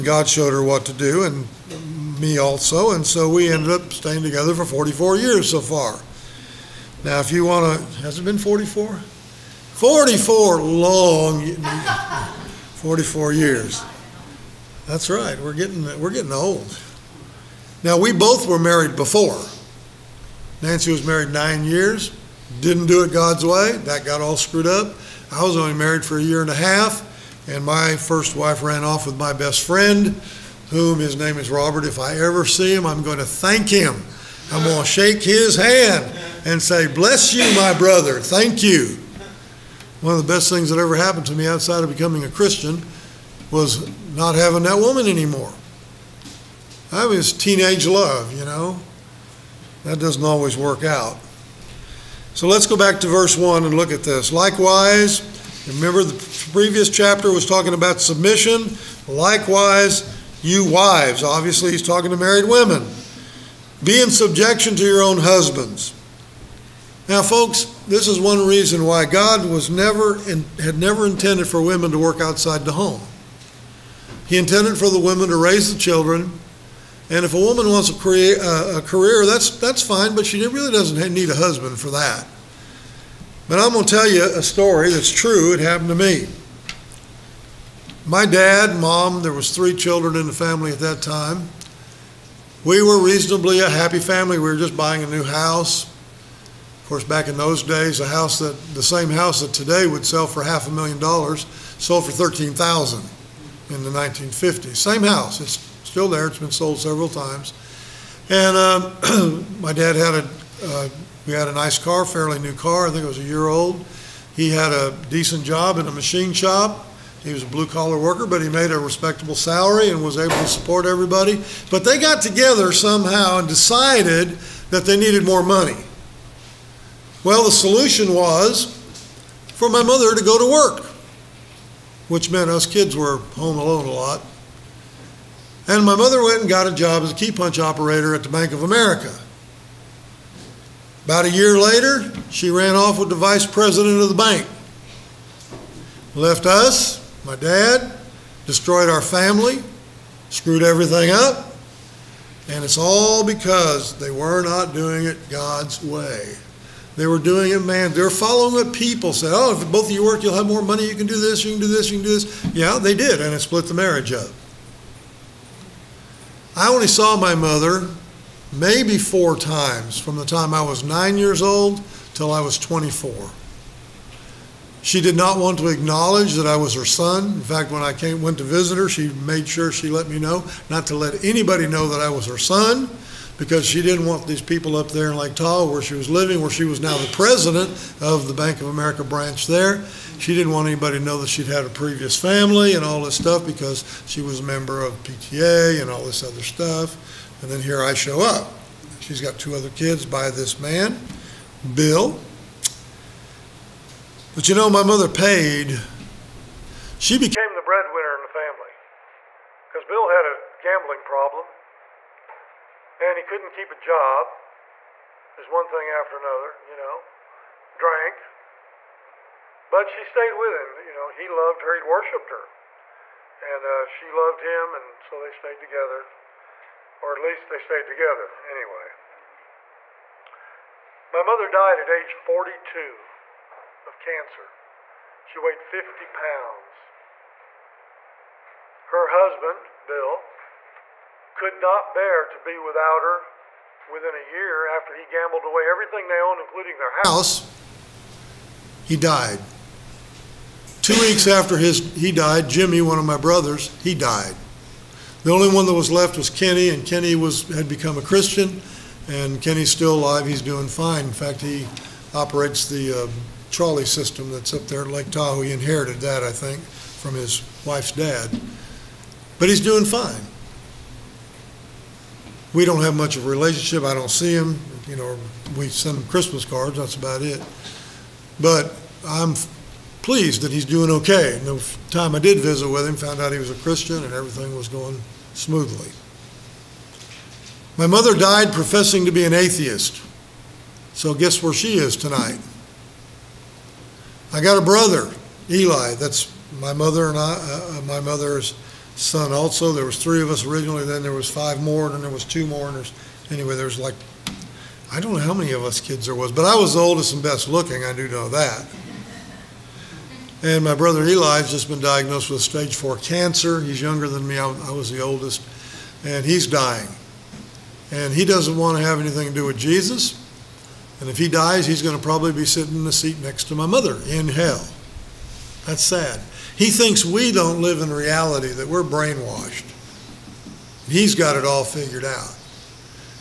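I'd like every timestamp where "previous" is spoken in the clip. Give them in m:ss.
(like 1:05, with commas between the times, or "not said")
0:56, 3:11.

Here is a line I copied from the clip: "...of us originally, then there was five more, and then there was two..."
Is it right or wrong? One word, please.
right.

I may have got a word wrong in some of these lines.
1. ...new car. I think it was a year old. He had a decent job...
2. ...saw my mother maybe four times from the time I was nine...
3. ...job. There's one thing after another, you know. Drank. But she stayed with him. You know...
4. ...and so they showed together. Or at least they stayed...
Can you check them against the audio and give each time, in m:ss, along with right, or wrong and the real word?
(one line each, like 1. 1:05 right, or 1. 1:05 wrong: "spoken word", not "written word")
1. 1:52 right
2. 2:46 right
3. 3:33 right
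4. 3:44 wrong: "stayed", not "showed".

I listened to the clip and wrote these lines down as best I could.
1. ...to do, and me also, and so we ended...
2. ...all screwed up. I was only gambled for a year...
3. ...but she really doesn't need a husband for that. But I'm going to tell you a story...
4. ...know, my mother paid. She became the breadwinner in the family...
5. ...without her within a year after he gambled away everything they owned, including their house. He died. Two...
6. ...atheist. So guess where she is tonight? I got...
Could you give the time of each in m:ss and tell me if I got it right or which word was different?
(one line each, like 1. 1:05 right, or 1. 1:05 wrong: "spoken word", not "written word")
1. 0:00 right
2. 0:24 wrong: "married", not "gambled"
3. 1:20 right
4. 3:24 right
5. 4:02 right
6. 4:49 right.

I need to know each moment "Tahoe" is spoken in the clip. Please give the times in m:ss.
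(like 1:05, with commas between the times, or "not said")
3:05, 4:25.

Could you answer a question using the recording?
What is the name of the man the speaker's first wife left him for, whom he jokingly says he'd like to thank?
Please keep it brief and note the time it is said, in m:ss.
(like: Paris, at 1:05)
Robert, at 0:31.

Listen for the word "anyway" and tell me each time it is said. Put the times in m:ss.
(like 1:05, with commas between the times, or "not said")
3:48, 5:03.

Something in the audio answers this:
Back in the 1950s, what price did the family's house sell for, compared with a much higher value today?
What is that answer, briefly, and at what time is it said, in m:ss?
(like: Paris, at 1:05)
$13,000, at 1:42.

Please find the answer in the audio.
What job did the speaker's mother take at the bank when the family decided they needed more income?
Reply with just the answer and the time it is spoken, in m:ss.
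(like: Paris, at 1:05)
Key punch operator, at 2:17.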